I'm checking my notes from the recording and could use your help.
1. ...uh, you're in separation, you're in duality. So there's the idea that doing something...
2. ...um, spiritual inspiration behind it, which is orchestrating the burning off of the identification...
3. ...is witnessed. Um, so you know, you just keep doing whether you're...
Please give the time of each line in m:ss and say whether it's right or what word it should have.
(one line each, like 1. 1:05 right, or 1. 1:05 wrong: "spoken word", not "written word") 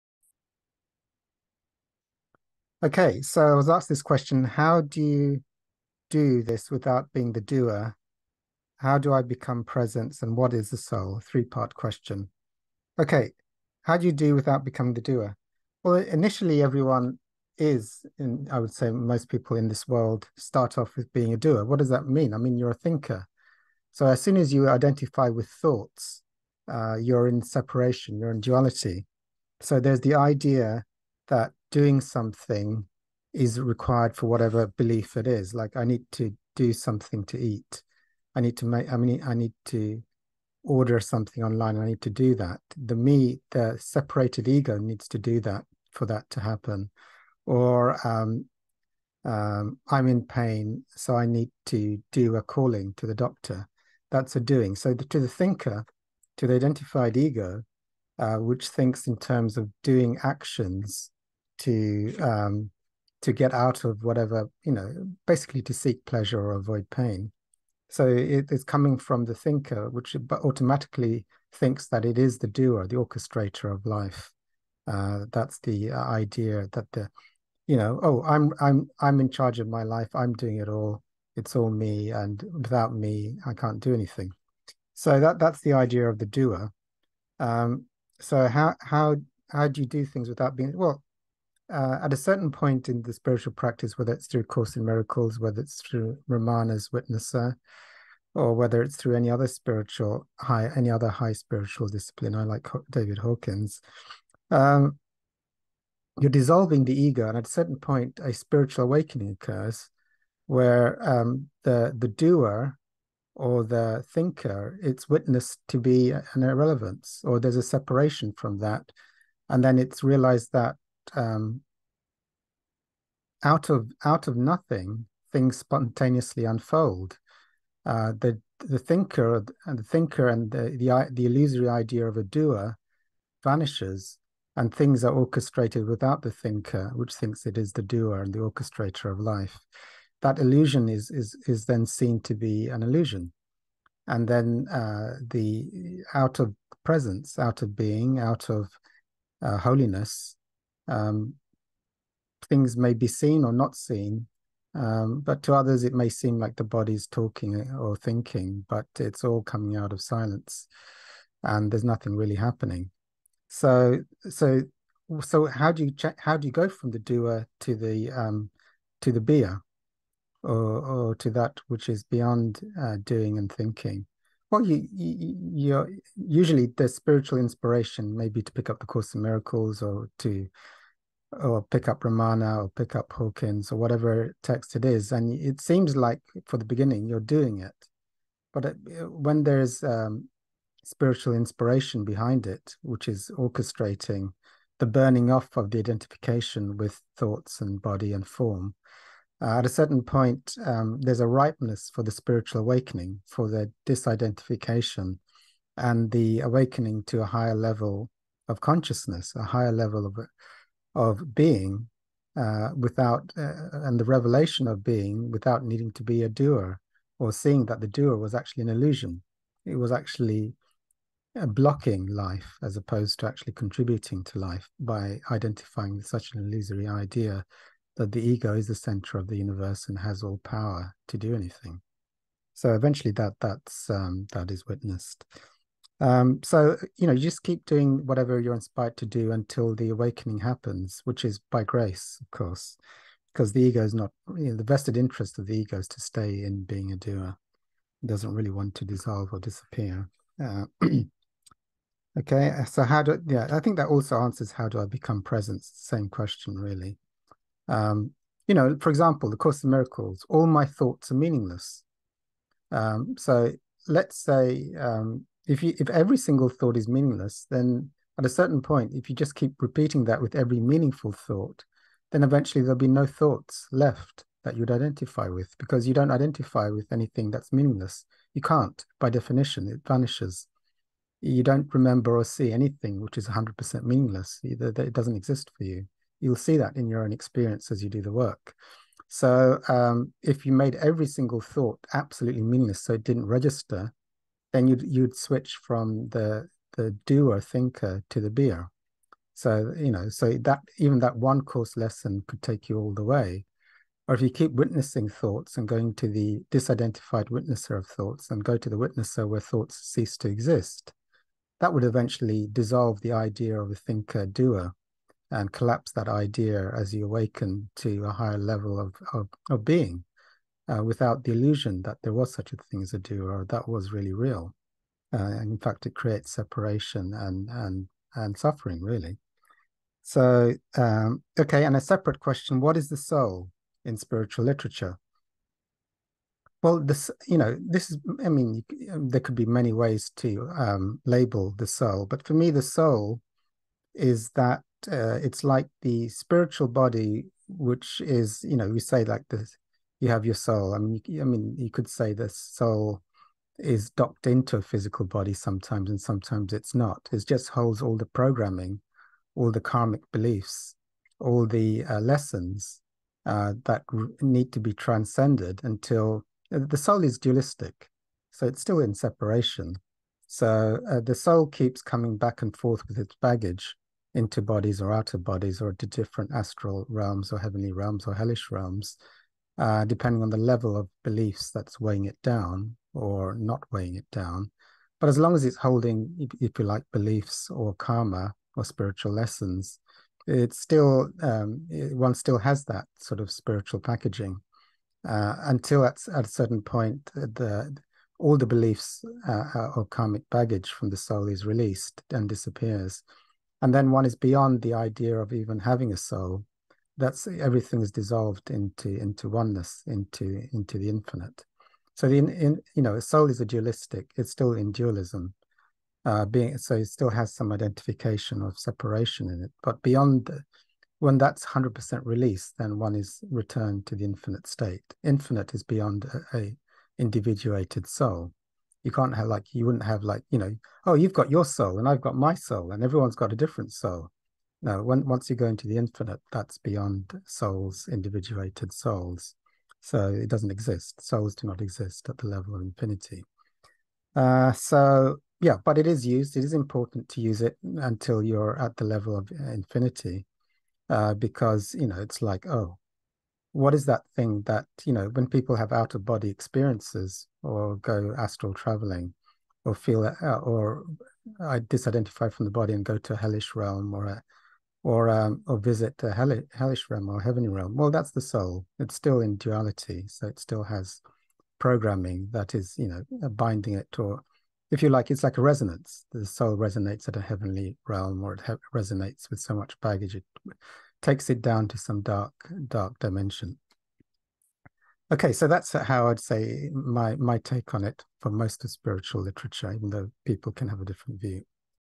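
1. 0:26 right
2. 3:09 right
3. 3:54 wrong: "whatever", not "whether".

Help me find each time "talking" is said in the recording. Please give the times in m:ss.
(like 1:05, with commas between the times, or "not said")
2:37.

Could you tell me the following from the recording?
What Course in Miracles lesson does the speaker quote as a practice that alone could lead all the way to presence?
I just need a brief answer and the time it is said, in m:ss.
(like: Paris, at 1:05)
All my thoughts are meaningless, at 4:20.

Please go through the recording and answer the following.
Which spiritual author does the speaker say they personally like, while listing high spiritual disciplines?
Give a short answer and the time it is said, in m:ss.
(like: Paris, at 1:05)
David Hawkins, at 1:42.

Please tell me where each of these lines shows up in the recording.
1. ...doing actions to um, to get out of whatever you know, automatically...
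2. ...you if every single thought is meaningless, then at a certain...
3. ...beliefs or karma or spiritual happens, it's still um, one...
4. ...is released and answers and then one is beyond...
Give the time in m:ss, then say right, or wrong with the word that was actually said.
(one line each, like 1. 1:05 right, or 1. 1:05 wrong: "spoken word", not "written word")
1. 0:59 wrong: "basically", not "automatically"
2. 4:25 right
3. 6:26 wrong: "lessons", not "happens"
4. 6:41 wrong: "disappears", not "answers".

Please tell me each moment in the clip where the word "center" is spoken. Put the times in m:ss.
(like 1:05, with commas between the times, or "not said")
3:48.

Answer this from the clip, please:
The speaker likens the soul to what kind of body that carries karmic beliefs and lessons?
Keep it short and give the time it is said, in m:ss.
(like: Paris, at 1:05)
Spiritual body, at 5:46.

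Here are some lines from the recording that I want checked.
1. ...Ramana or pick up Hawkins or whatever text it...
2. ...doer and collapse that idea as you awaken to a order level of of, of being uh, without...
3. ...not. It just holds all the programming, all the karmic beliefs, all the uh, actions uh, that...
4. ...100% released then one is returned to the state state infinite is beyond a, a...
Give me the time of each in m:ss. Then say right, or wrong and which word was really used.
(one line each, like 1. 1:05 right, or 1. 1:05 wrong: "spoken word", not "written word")
1. 3:02 right
2. 5:14 wrong: "higher", not "order"
3. 5:56 wrong: "lessons", not "actions"
4. 7:01 wrong: "infinite", not "state".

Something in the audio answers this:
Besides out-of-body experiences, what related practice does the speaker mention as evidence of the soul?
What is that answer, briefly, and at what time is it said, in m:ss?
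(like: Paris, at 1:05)
Astral traveling, at 7:38.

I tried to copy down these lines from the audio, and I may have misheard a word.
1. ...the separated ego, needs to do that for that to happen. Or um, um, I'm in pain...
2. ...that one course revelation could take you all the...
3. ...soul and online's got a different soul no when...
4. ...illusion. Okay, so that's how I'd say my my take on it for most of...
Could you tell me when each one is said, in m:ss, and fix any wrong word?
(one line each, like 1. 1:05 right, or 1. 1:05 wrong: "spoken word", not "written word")
1. 0:43 right
2. 5:00 wrong: "lesson", not "revelation"
3. 7:12 wrong: "everyone", not "online"
4. 8:02 wrong: "dimension", not "illusion".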